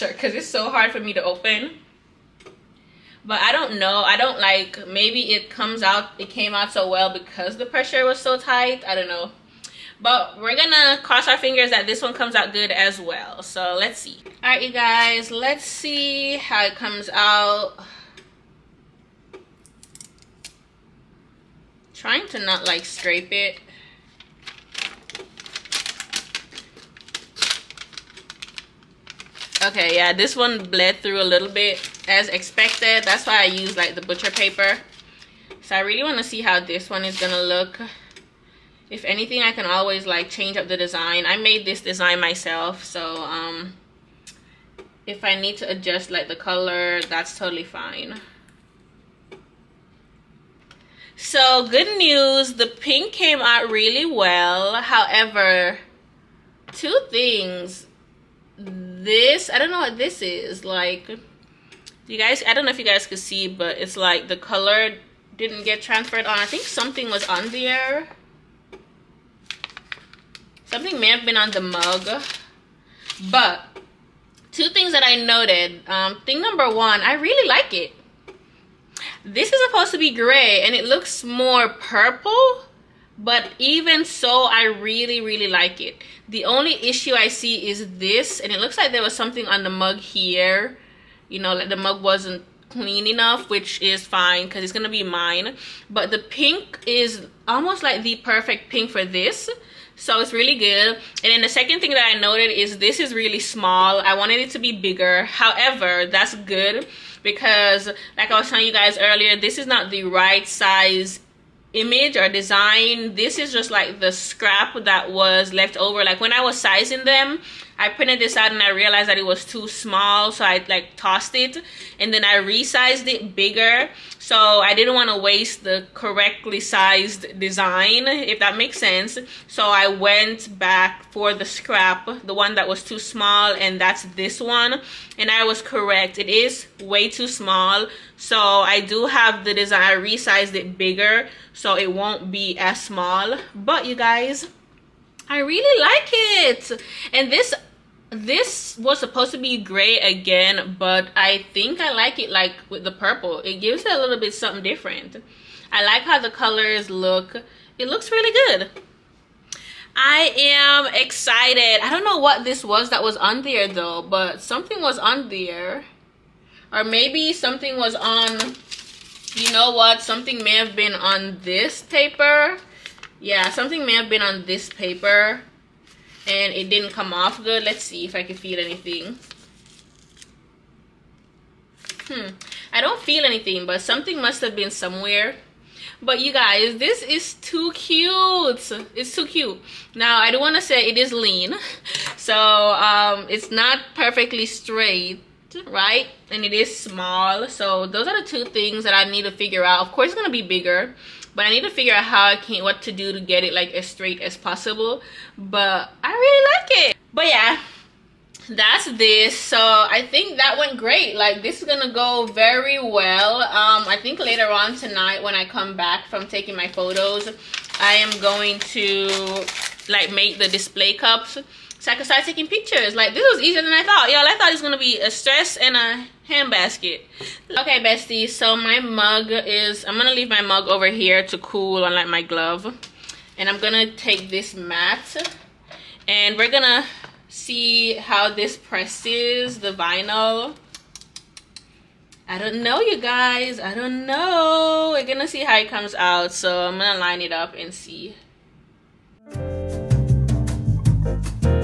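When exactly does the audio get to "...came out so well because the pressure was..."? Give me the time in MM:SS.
00:06.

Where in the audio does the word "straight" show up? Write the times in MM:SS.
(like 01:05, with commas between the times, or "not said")
03:14, 03:23.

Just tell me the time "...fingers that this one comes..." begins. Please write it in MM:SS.
00:11.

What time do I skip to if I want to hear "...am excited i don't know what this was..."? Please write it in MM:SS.
02:40.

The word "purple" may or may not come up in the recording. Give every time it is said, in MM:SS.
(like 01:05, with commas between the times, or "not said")
01:21, 02:32.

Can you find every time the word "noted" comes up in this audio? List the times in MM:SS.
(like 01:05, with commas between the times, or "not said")
01:15, 01:42.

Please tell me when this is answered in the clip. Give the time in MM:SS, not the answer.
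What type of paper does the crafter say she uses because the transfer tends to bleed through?
00:33.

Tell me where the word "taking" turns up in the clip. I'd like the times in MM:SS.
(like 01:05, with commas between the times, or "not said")
03:36, 03:42.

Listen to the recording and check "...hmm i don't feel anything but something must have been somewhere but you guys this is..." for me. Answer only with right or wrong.
right.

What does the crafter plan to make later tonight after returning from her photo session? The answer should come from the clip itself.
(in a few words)
Display cups.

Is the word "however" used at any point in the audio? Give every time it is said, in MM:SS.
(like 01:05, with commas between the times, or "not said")
00:54, 01:45.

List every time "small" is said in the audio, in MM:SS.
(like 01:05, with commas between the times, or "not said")
01:43, 01:59, 02:12, 02:17, 02:22, 03:16.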